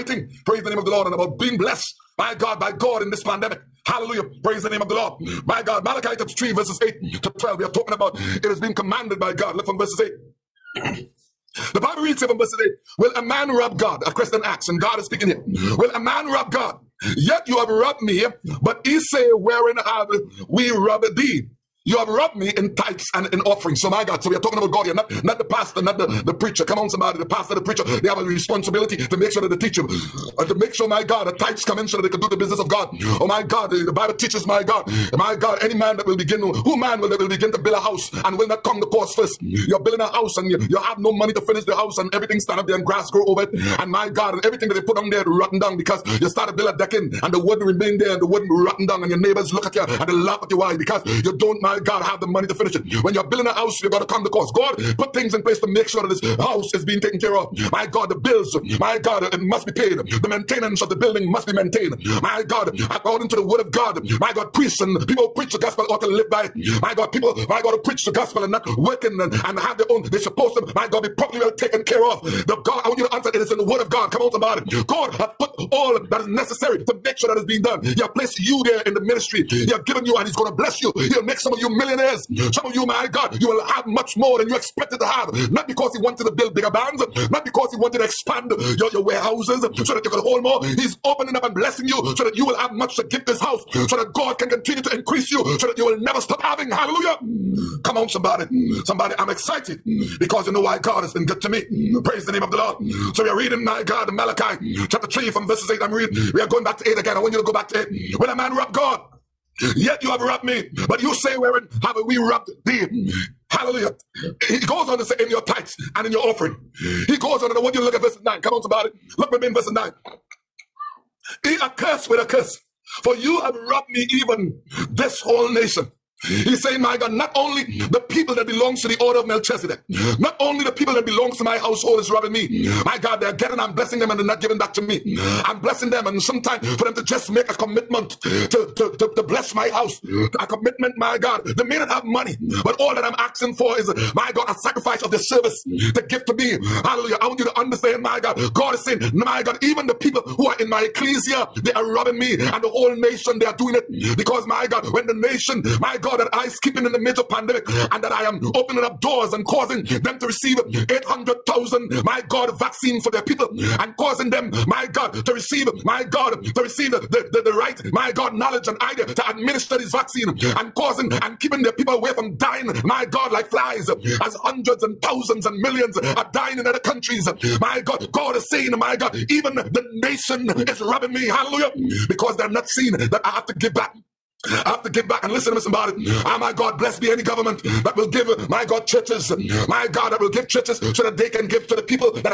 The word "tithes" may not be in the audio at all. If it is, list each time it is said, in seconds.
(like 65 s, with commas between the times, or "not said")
22 s, 31 s, 115 s.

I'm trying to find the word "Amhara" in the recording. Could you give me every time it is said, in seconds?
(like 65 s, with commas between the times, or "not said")
not said.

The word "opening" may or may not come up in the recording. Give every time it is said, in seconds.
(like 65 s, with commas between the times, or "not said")
91 s, 158 s.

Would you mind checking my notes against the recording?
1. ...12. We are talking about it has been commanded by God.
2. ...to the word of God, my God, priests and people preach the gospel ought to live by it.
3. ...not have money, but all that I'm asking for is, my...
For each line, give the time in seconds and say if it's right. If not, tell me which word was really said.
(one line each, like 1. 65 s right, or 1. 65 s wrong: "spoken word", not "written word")
1. 7 s right
2. 63 s right
3. 141 s right.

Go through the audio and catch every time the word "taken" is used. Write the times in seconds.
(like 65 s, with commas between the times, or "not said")
57 s, 71 s.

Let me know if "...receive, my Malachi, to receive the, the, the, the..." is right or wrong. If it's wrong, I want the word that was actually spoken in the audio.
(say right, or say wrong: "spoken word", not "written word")
wrong: "God", not "Malachi".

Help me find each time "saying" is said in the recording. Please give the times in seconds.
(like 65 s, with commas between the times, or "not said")
126 s, 148 s, 178 s.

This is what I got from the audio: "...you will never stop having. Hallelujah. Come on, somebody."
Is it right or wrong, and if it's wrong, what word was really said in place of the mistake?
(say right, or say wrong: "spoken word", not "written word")
right.